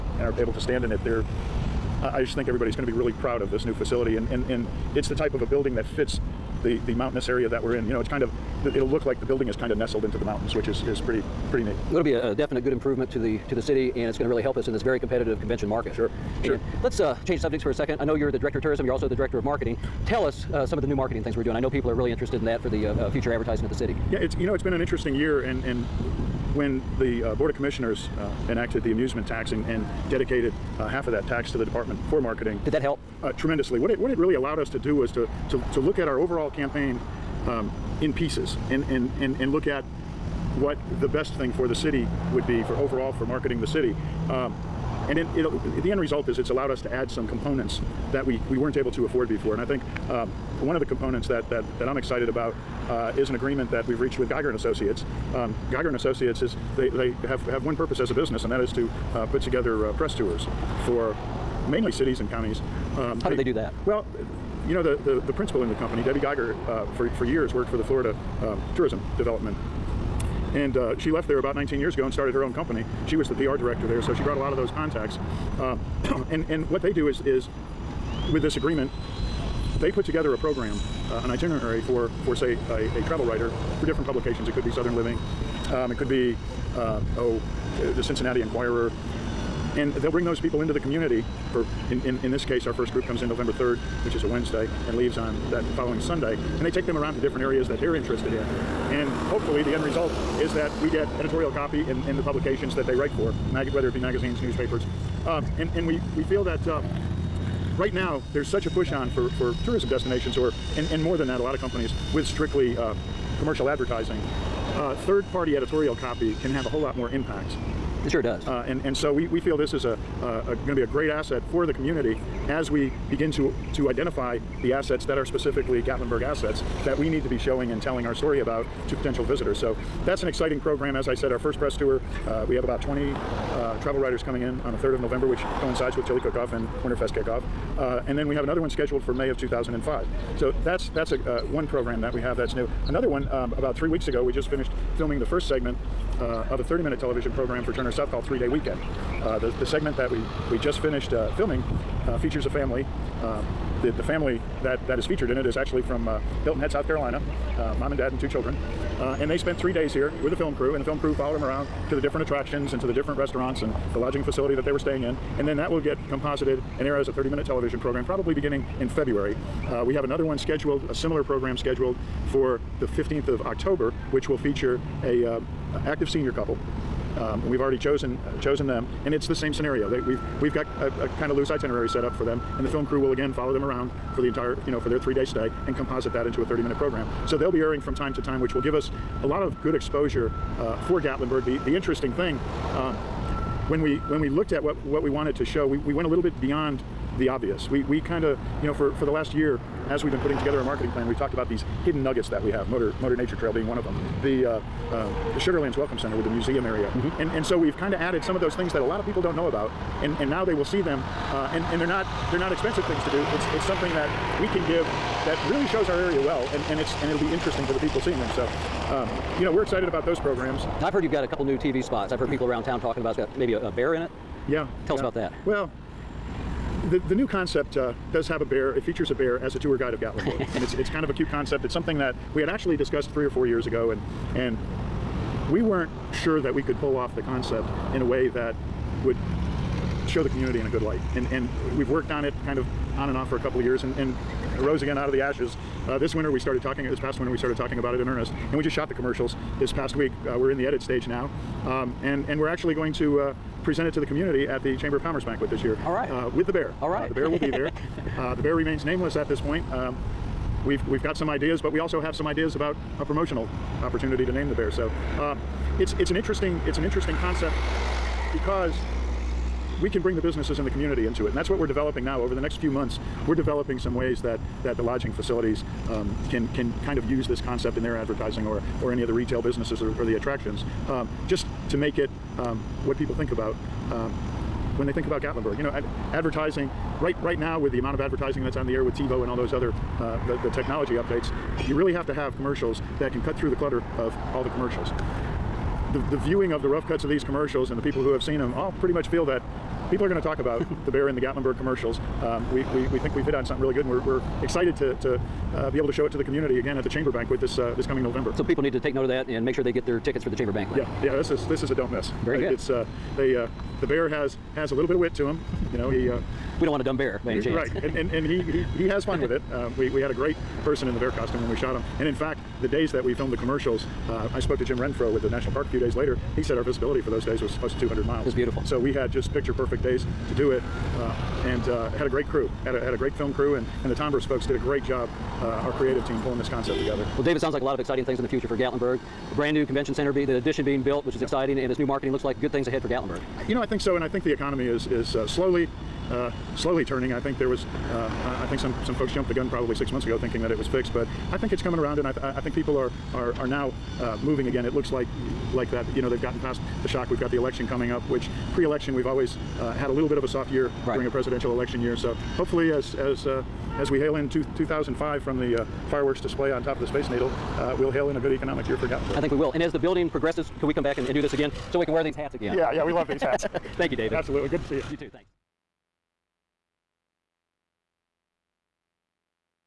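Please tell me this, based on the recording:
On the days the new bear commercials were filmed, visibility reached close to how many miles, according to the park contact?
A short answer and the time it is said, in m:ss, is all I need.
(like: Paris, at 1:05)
200 miles, at 5:27.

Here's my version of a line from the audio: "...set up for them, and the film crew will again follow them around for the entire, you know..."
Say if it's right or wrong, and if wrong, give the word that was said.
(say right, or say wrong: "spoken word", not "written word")
right.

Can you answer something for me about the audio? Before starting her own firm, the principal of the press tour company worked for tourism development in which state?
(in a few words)
Florida.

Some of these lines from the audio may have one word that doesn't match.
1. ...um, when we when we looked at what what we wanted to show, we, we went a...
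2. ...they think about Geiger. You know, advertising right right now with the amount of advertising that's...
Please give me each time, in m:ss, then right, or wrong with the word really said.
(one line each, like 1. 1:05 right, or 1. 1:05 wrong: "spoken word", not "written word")
1. 3:12 right
2. 4:44 wrong: "Gatlinburg", not "Geiger".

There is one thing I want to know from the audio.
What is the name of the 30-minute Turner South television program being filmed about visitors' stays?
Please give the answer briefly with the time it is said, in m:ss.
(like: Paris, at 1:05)
Three Day Weekend, at 2:28.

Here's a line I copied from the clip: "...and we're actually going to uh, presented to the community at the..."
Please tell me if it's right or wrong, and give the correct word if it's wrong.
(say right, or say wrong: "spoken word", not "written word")
right.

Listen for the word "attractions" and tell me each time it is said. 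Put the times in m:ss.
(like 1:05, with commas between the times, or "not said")
2:42, 4:40.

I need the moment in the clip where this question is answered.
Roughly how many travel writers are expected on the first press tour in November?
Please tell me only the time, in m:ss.
2:12.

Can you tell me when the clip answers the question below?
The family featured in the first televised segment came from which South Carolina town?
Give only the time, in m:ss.
2:36.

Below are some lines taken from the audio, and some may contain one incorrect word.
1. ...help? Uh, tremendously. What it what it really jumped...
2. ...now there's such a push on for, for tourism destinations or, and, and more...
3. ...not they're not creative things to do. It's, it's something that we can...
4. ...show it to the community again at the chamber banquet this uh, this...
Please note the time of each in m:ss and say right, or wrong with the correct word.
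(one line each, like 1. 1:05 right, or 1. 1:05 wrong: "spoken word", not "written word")
1. 0:32 wrong: "allowed", not "jumped"
2. 1:47 right
3. 3:31 wrong: "expensive", not "creative"
4. 5:05 right.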